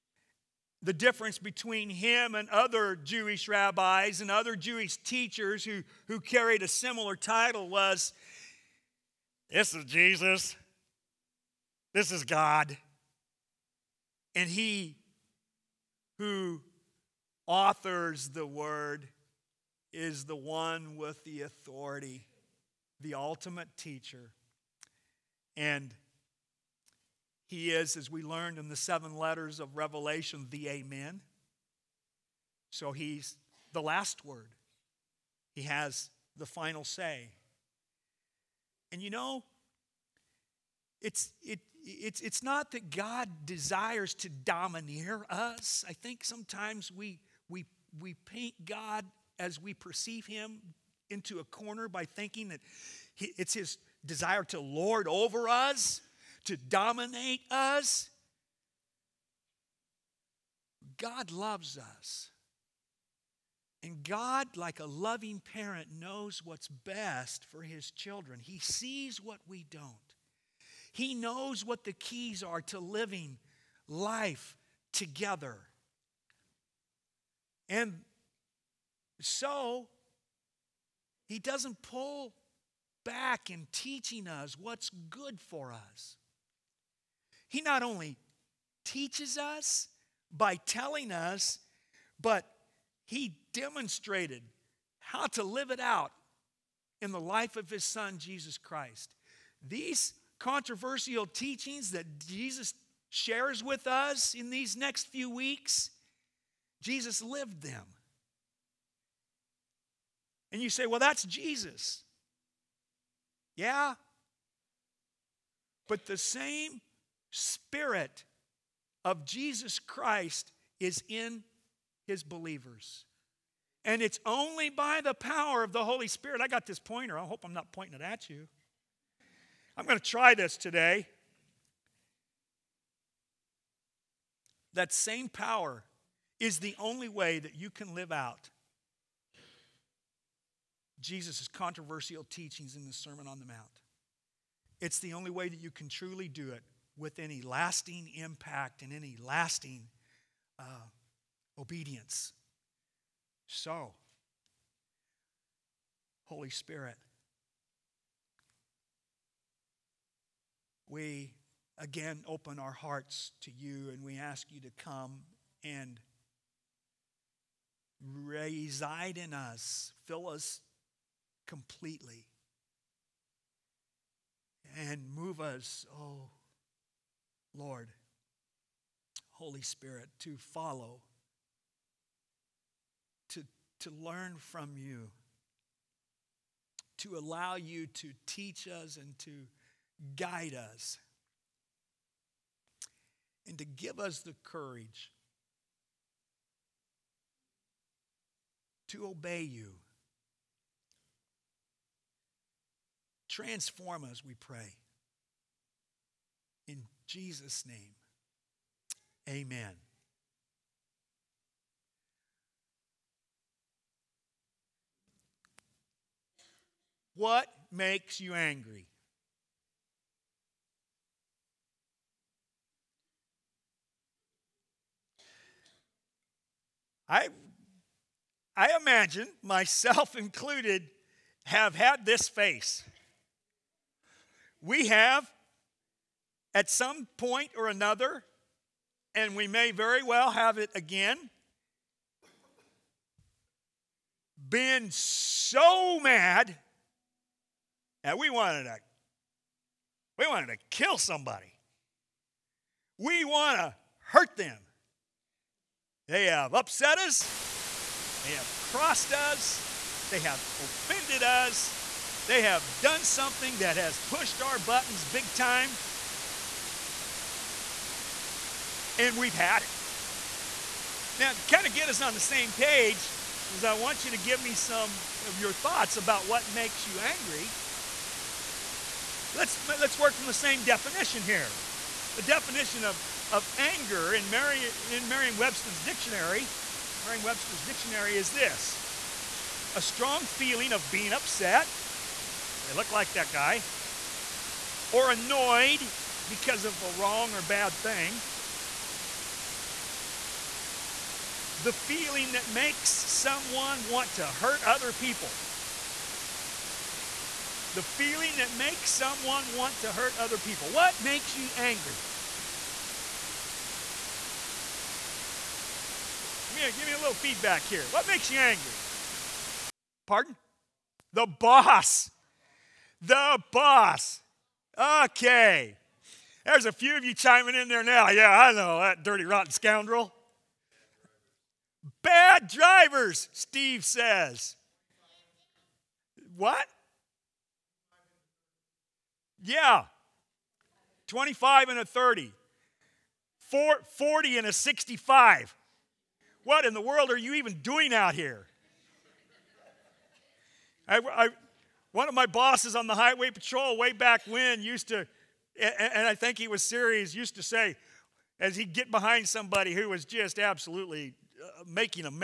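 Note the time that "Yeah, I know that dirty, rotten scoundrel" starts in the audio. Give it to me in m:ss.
5:28.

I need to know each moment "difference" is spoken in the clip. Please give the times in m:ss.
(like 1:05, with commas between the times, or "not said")
0:00.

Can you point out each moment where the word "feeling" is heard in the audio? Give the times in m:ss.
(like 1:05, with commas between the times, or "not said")
4:50, 5:01, 5:07.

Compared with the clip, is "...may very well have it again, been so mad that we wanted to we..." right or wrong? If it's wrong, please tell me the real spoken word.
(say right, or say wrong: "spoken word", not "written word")
right.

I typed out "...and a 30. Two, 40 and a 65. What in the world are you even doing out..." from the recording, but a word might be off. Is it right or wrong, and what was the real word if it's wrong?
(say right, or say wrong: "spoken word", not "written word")
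wrong: "Four", not "Two".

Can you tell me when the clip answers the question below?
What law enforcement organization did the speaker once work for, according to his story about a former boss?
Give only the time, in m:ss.
5:52.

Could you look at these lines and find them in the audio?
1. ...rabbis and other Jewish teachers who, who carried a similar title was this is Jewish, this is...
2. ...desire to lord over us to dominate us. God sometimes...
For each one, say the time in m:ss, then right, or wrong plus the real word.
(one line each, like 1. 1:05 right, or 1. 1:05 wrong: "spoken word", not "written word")
1. 0:03 wrong: "Jesus", not "Jewish"
2. 0:54 wrong: "loves", not "sometimes".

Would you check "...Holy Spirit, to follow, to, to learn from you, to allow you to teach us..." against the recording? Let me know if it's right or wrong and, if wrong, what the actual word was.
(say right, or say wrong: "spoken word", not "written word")
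right.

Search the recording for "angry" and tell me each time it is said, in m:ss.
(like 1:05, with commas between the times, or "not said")
3:38, 4:36, 5:11, 5:18.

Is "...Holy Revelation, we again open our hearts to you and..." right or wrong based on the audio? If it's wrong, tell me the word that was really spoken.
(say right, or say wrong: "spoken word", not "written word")
wrong: "Spirit", not "Revelation".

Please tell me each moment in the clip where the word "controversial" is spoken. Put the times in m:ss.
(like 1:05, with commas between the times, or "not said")
1:40, 2:21.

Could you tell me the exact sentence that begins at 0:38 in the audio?
And you know, it's, it, it's, it's not that God desires to domineer us.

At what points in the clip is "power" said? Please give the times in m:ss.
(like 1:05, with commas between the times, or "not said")
2:05, 2:15.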